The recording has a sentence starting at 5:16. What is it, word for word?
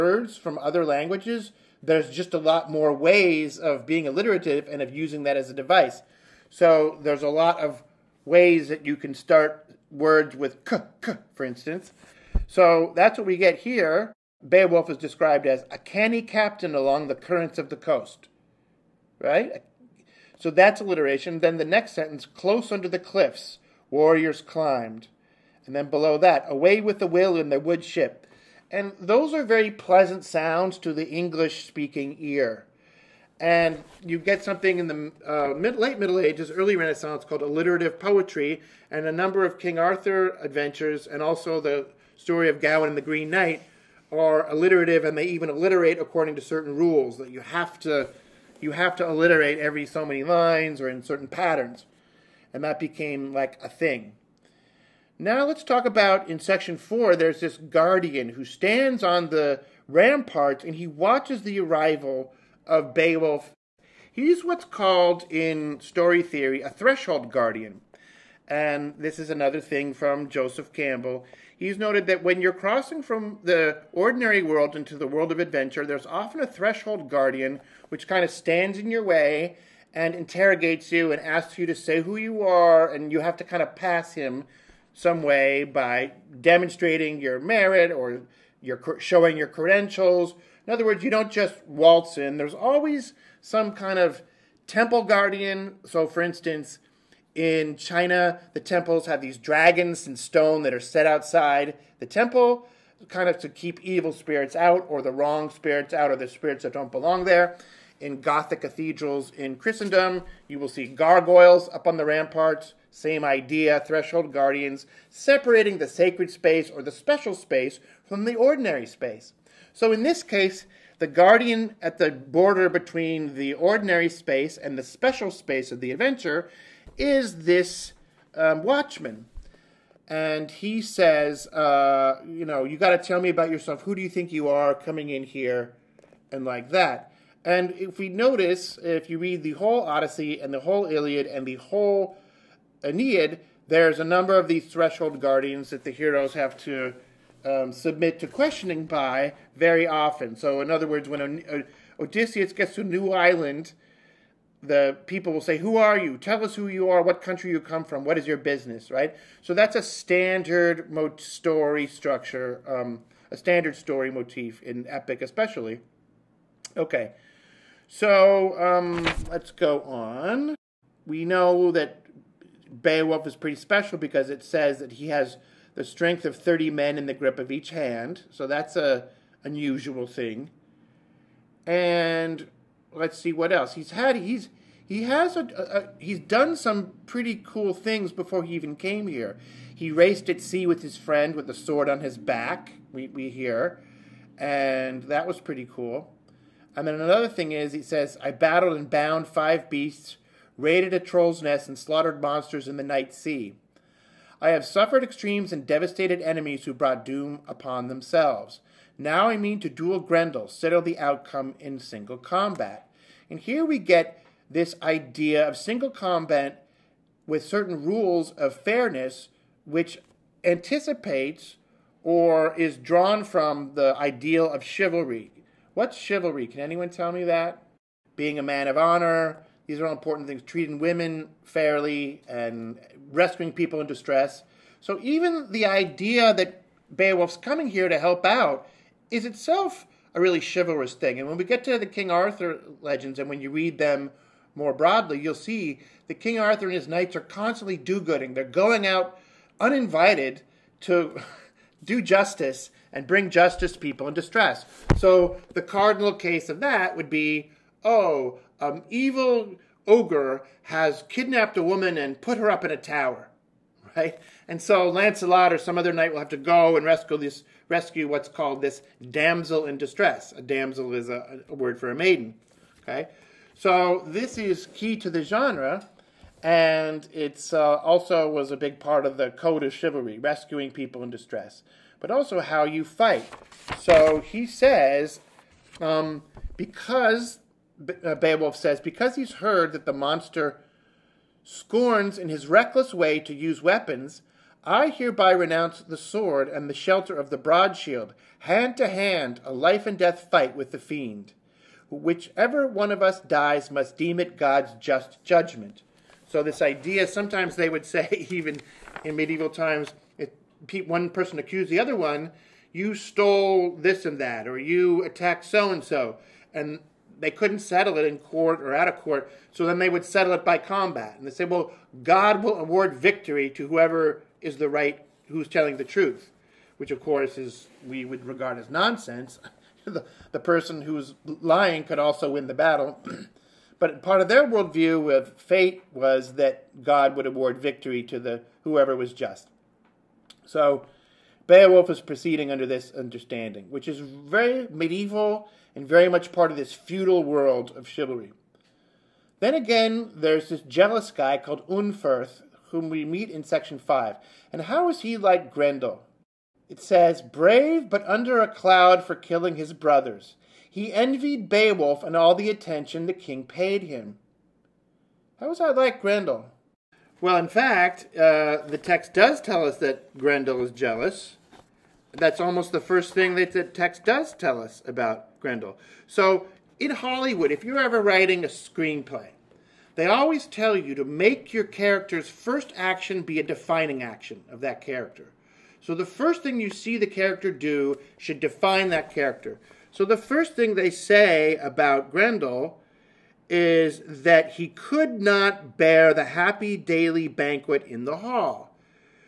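And they couldn't settle it in court or out of court, so then they would settle it by combat.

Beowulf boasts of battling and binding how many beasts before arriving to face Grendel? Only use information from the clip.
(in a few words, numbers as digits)
5.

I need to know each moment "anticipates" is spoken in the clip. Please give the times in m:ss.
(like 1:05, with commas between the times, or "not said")
3:40.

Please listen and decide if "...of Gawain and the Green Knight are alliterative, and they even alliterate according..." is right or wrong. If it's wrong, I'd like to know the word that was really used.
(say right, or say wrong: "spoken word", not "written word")
right.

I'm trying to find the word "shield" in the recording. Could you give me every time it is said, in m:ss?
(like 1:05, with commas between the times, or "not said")
4:57.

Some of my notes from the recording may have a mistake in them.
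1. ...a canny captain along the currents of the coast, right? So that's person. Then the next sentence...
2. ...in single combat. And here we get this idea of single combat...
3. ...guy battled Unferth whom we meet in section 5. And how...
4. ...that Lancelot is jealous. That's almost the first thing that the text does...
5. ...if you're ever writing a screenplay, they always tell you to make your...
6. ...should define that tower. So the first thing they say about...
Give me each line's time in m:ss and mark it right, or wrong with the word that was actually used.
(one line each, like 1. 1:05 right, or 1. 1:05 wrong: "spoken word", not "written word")
1. 0:15 wrong: "alliteration", not "person"
2. 3:31 right
3. 5:51 wrong: "called", not "battled"
4. 6:09 wrong: "Grendel", not "Lancelot"
5. 6:17 right
6. 6:28 wrong: "character", not "tower".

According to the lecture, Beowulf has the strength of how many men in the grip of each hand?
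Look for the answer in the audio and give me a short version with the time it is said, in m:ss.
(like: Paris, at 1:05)
30, at 2:56.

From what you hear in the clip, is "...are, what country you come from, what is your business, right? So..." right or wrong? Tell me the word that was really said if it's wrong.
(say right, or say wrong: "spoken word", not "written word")
right.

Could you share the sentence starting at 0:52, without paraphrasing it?
And that became like a thing.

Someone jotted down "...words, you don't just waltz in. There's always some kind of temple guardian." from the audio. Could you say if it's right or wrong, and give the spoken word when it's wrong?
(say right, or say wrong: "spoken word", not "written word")
right.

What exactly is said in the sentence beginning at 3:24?
I have suffered extremes and devastated enemies who brought doom upon themselves.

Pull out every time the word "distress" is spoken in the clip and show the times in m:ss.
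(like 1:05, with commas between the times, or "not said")
3:53, 4:14, 4:29, 4:41.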